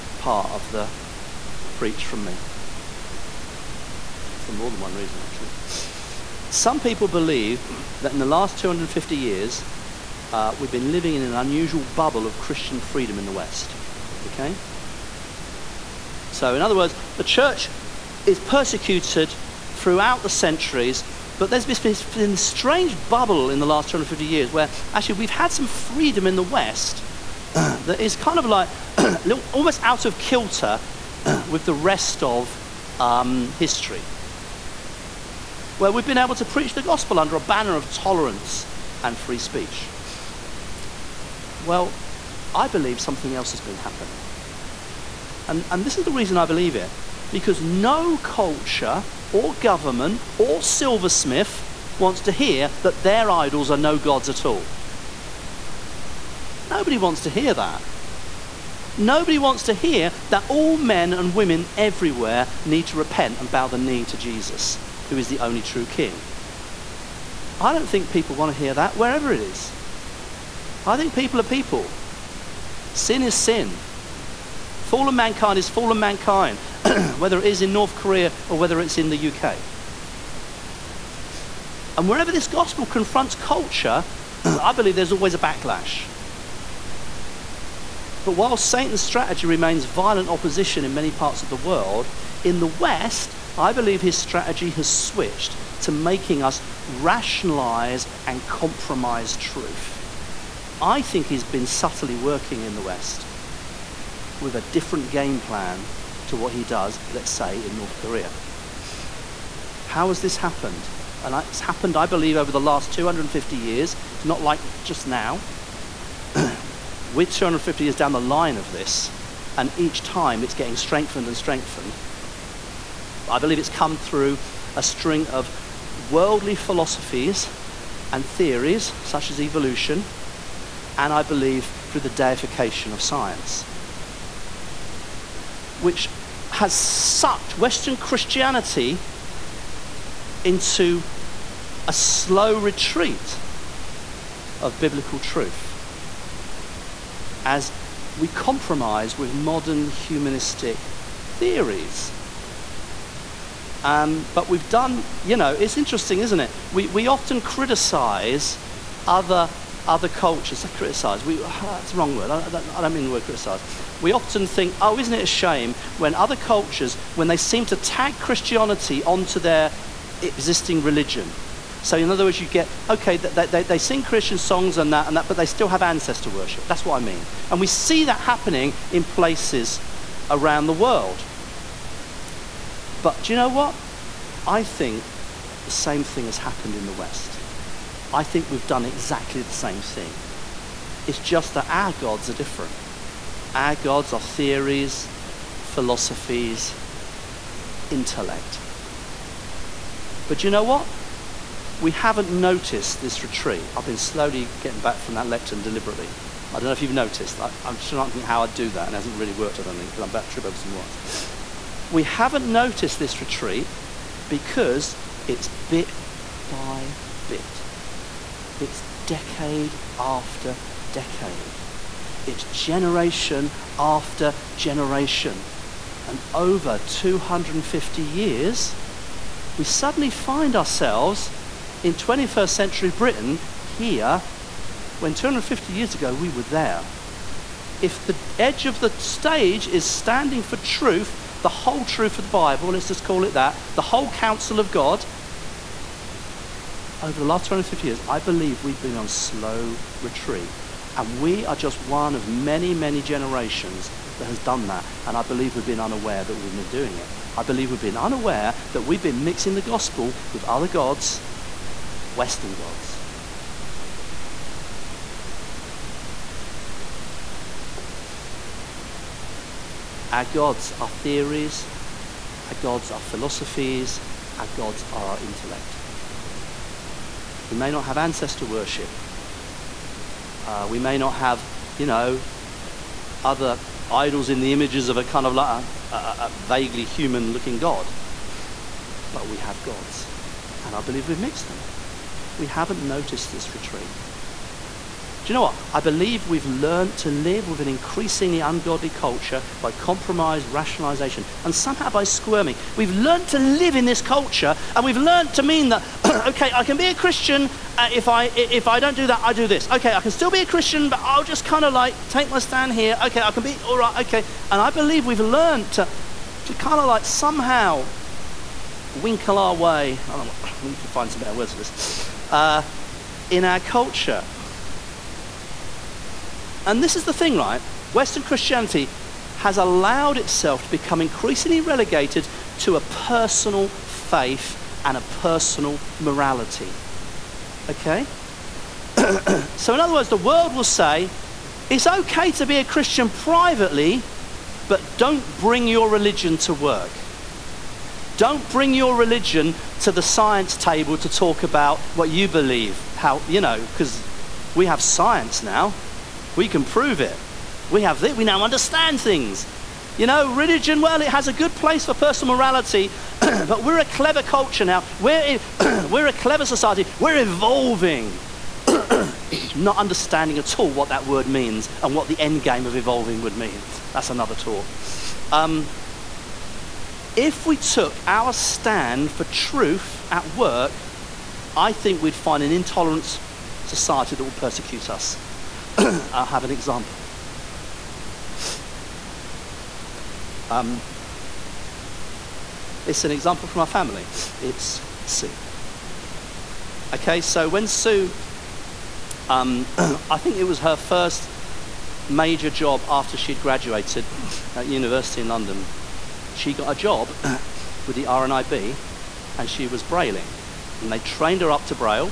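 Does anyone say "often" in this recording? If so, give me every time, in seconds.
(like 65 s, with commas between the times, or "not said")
157 s, 164 s.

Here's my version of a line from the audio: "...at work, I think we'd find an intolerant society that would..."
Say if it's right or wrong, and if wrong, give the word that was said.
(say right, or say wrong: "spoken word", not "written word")
right.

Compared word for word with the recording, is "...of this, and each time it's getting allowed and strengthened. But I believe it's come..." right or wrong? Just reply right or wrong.
wrong.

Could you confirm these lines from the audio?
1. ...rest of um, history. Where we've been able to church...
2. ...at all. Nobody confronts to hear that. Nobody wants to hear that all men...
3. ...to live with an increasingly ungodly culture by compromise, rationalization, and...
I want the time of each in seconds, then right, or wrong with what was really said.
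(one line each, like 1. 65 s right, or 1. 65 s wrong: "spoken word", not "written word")
1. 31 s wrong: "preach", not "church"
2. 54 s wrong: "wants", not "confronts"
3. 296 s right.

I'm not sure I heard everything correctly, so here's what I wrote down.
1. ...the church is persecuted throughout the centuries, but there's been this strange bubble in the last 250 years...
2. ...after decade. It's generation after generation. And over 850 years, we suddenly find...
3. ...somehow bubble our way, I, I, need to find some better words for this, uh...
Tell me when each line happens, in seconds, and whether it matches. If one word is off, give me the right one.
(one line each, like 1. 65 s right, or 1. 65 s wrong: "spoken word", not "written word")
1. 17 s right
2. 219 s wrong: "250", not "850"
3. 317 s wrong: "winkle", not "bubble".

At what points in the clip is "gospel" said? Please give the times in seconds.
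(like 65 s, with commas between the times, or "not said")
36 s, 82 s, 259 s.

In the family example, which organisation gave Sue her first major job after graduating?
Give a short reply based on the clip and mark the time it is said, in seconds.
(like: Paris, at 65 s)
RNIB, at 408 s.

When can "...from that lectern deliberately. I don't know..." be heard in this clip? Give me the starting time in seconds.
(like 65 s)
204 s.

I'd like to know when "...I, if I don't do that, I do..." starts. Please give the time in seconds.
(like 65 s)
308 s.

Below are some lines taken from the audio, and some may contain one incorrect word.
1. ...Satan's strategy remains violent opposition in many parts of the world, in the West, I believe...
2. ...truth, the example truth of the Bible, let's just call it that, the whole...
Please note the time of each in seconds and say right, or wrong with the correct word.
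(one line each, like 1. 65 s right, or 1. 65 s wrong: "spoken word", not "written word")
1. 88 s right
2. 240 s wrong: "whole", not "example".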